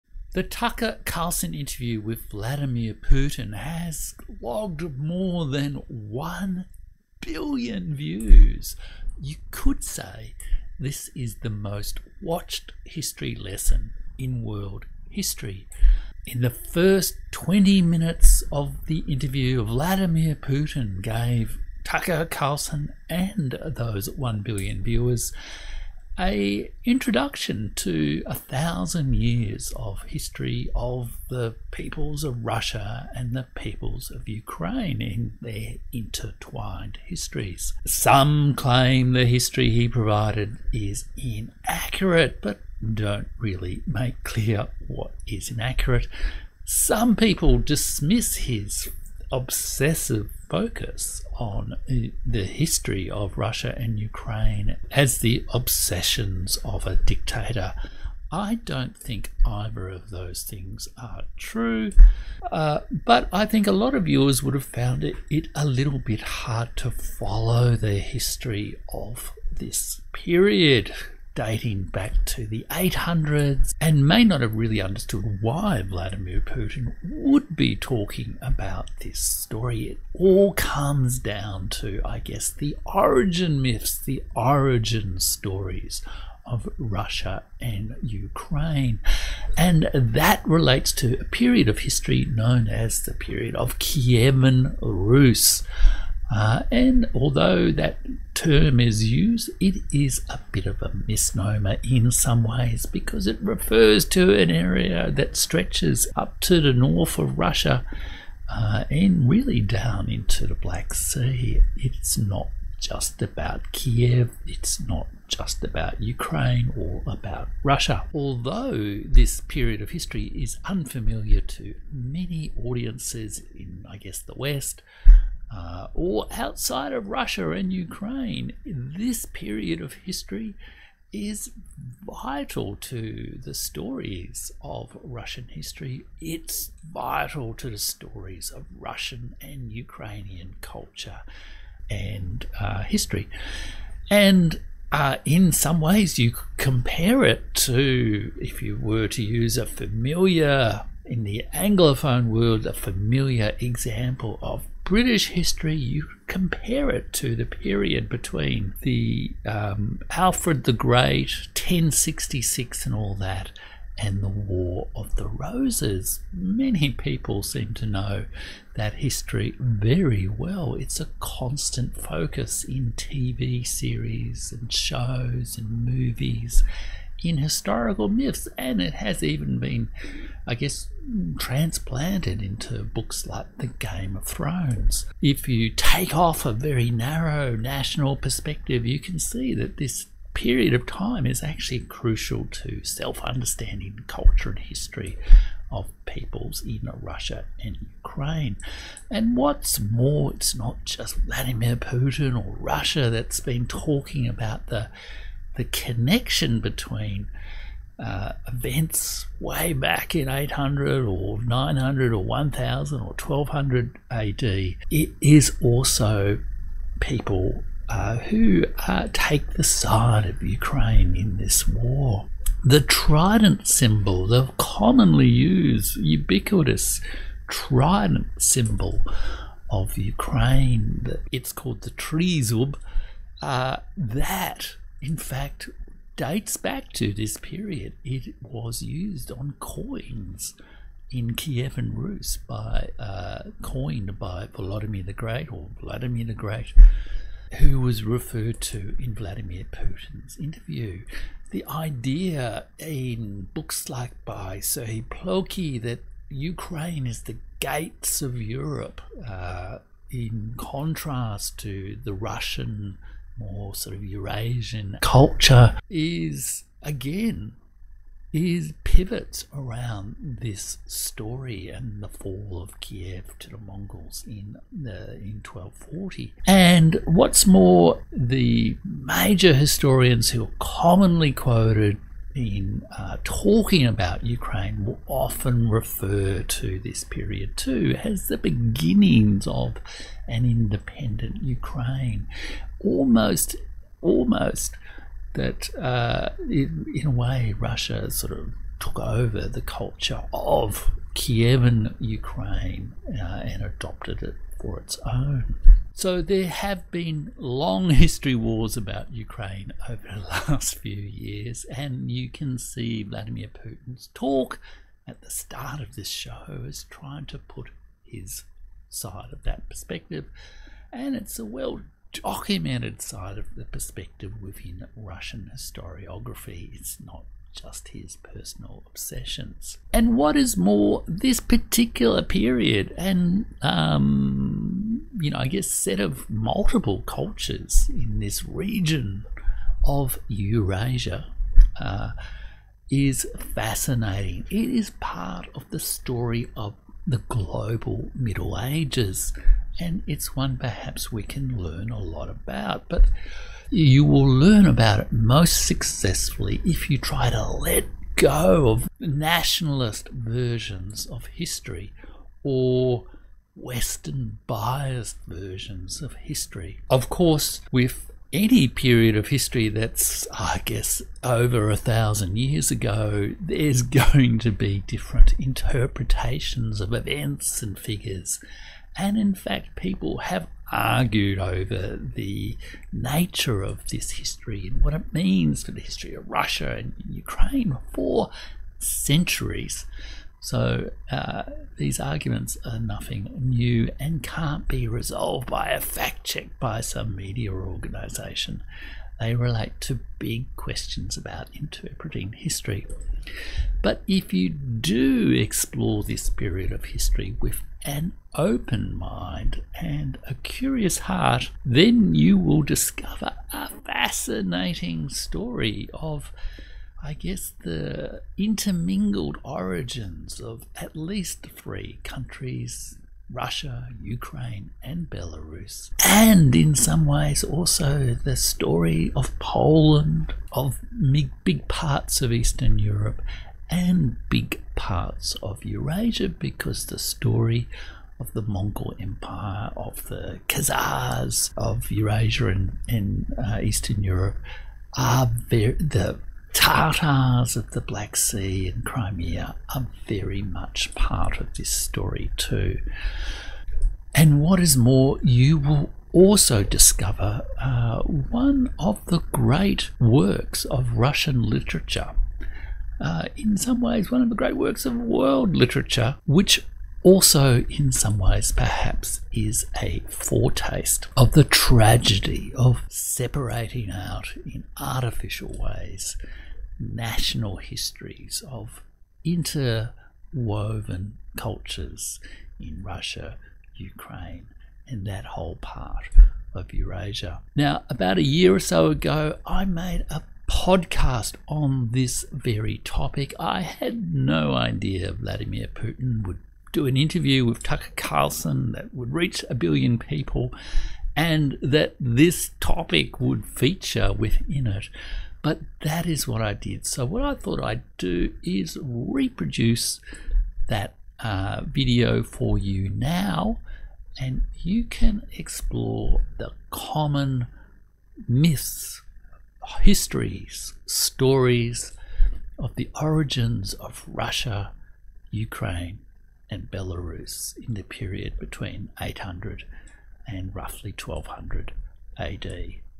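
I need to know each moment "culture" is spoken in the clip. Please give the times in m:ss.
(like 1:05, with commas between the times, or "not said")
2:20, 3:14, 4:25, 4:59, 5:37, 8:01.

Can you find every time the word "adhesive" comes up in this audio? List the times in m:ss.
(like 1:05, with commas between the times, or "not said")
not said.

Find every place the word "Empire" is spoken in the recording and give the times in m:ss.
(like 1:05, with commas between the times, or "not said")
7:18.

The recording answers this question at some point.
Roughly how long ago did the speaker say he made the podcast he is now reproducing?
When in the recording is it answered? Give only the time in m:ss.
8:07.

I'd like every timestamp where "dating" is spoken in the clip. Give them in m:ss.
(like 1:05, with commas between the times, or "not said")
1:11.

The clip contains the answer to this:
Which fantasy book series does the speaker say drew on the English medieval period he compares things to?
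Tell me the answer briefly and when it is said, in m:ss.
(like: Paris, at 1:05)
The Game of Thrones, at 3:03.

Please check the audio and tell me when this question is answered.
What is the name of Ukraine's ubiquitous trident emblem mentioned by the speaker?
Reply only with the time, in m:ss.
3:51.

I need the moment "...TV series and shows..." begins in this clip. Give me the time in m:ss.
2:52.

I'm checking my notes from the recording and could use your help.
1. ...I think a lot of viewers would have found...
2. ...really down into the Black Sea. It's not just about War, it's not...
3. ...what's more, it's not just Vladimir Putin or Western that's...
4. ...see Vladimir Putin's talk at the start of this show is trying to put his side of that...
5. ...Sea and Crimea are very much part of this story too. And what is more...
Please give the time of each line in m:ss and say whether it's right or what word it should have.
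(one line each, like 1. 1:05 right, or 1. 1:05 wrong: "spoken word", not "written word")
1. 1:03 right
2. 1:49 wrong: "Kiev", not "War"
3. 3:19 wrong: "Russia", not "Western"
4. 5:12 right
5. 7:28 right.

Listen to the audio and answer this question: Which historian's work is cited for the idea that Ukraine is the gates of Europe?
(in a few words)
Serhiy Plokhy.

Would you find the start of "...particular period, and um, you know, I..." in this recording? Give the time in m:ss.
5:31.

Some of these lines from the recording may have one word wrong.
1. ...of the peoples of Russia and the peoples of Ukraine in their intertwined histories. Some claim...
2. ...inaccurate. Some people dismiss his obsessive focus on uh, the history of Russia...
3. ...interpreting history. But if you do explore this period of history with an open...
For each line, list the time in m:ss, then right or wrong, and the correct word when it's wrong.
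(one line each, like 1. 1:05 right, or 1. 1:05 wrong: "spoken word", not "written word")
1. 0:30 right
2. 0:45 right
3. 6:41 right.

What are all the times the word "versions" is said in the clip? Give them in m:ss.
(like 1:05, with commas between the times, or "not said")
6:00, 6:05.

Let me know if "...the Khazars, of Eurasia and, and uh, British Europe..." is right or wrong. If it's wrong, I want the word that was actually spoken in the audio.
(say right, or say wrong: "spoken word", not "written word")
wrong: "Eastern", not "British".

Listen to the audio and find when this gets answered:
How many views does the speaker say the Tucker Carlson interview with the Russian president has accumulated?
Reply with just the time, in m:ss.
0:04.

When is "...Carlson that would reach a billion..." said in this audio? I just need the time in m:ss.
8:17.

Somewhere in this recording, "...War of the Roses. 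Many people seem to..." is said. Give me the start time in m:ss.
2:44.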